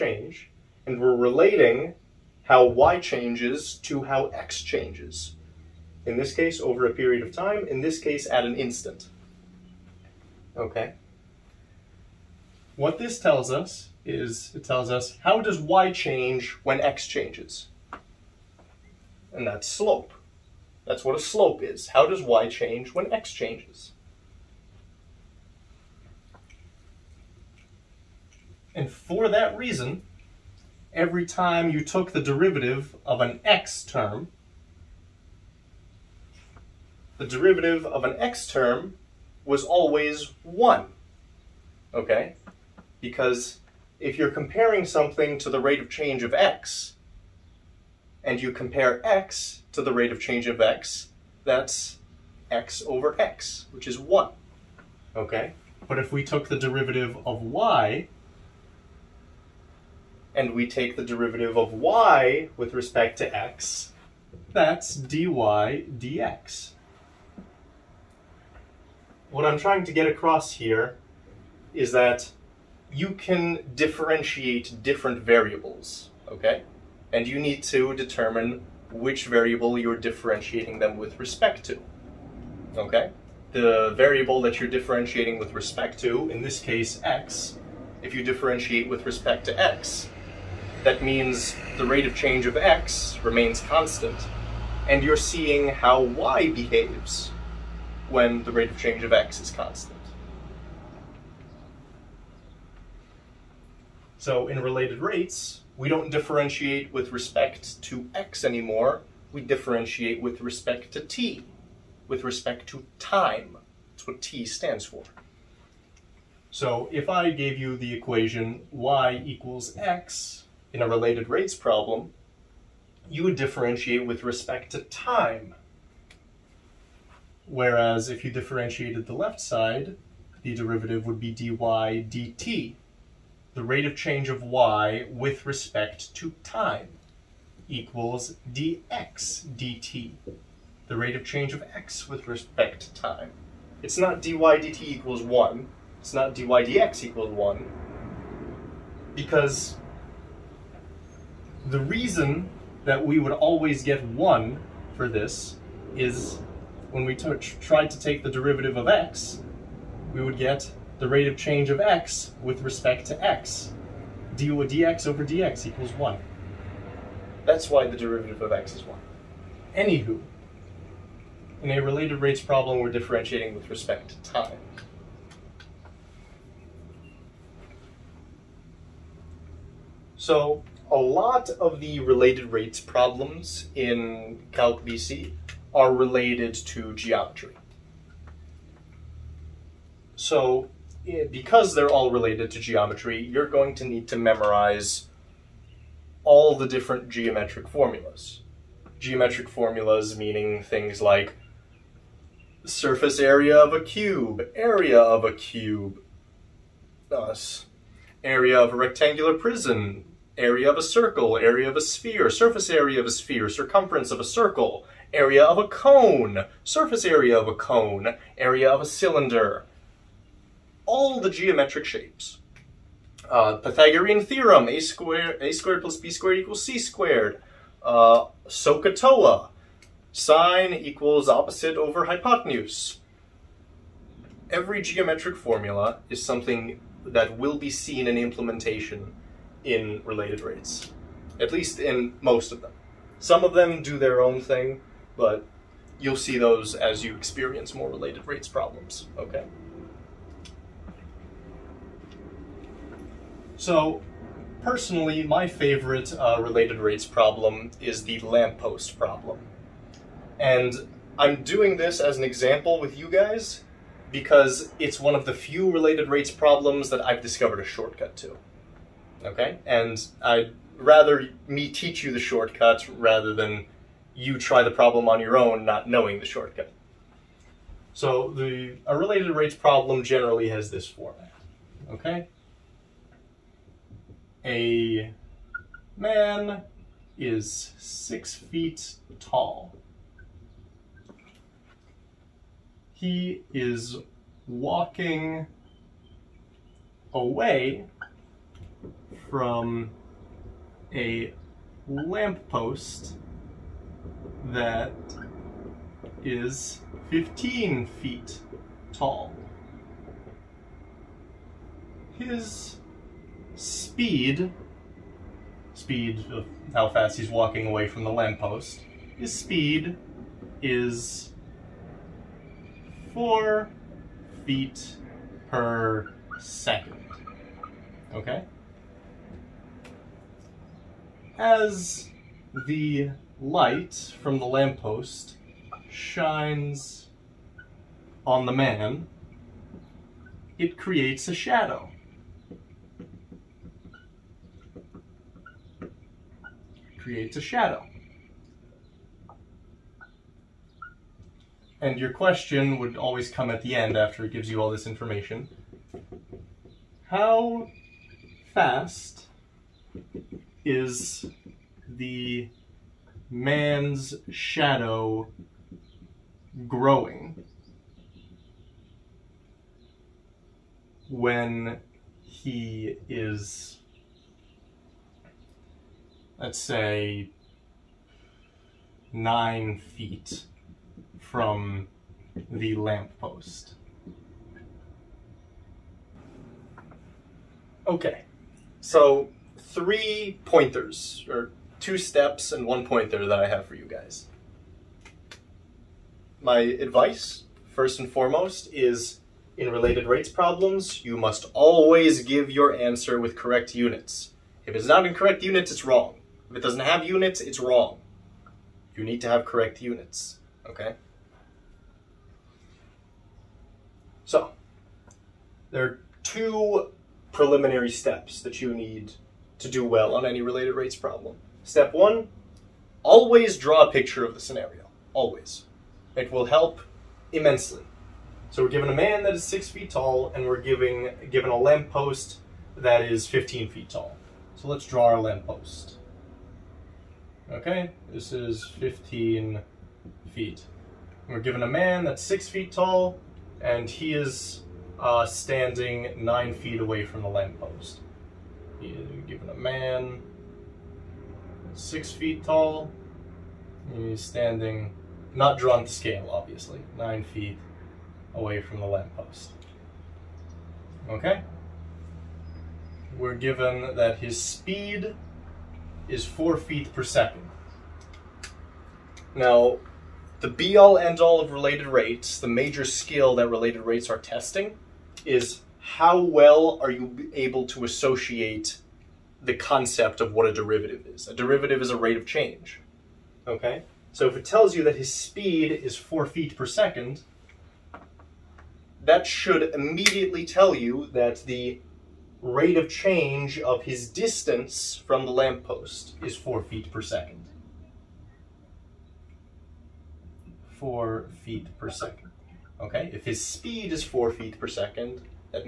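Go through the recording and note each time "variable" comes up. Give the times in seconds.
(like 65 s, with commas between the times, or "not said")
75 s, 79 s, 83 s.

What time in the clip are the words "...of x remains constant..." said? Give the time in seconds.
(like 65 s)
92 s.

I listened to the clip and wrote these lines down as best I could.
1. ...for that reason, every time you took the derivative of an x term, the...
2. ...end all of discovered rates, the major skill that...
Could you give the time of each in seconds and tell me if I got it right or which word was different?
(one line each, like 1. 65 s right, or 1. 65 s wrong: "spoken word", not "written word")
1. 28 s right
2. 470 s wrong: "related", not "discovered".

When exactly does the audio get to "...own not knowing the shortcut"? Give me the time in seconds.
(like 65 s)
275 s.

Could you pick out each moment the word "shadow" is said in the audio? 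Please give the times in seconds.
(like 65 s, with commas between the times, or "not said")
341 s, 347 s, 364 s.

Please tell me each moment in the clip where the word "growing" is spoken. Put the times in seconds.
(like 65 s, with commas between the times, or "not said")
366 s.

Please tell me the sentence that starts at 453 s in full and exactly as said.
He's standing, not drawn to scale, obviously, nine feet away from the lamppost.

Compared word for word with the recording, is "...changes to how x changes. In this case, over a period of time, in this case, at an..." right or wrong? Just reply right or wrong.
right.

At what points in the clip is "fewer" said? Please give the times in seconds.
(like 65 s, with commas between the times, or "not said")
not said.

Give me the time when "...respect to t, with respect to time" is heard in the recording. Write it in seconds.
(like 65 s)
110 s.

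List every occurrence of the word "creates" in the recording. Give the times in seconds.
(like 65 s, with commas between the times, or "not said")
340 s, 346 s.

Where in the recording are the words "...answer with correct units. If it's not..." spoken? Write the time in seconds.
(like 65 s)
402 s.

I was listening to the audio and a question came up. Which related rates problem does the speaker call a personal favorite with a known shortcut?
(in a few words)
The lamppost problem.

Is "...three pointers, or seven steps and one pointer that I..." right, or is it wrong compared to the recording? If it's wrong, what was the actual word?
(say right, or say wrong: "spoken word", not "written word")
wrong: "two", not "seven".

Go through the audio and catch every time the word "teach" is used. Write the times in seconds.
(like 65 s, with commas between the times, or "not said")
271 s.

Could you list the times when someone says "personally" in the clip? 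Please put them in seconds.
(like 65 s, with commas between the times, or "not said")
254 s.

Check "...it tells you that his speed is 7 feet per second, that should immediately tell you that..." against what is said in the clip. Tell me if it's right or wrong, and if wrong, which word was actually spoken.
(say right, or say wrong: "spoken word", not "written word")
wrong: "4", not "7".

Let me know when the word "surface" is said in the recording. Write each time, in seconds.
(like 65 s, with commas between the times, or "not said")
202 s, 212 s, 216 s.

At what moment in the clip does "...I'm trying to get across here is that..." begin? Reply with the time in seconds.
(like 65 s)
69 s.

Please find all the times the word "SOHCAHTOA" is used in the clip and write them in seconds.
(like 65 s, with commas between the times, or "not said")
228 s.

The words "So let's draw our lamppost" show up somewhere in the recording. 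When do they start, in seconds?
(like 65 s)
434 s.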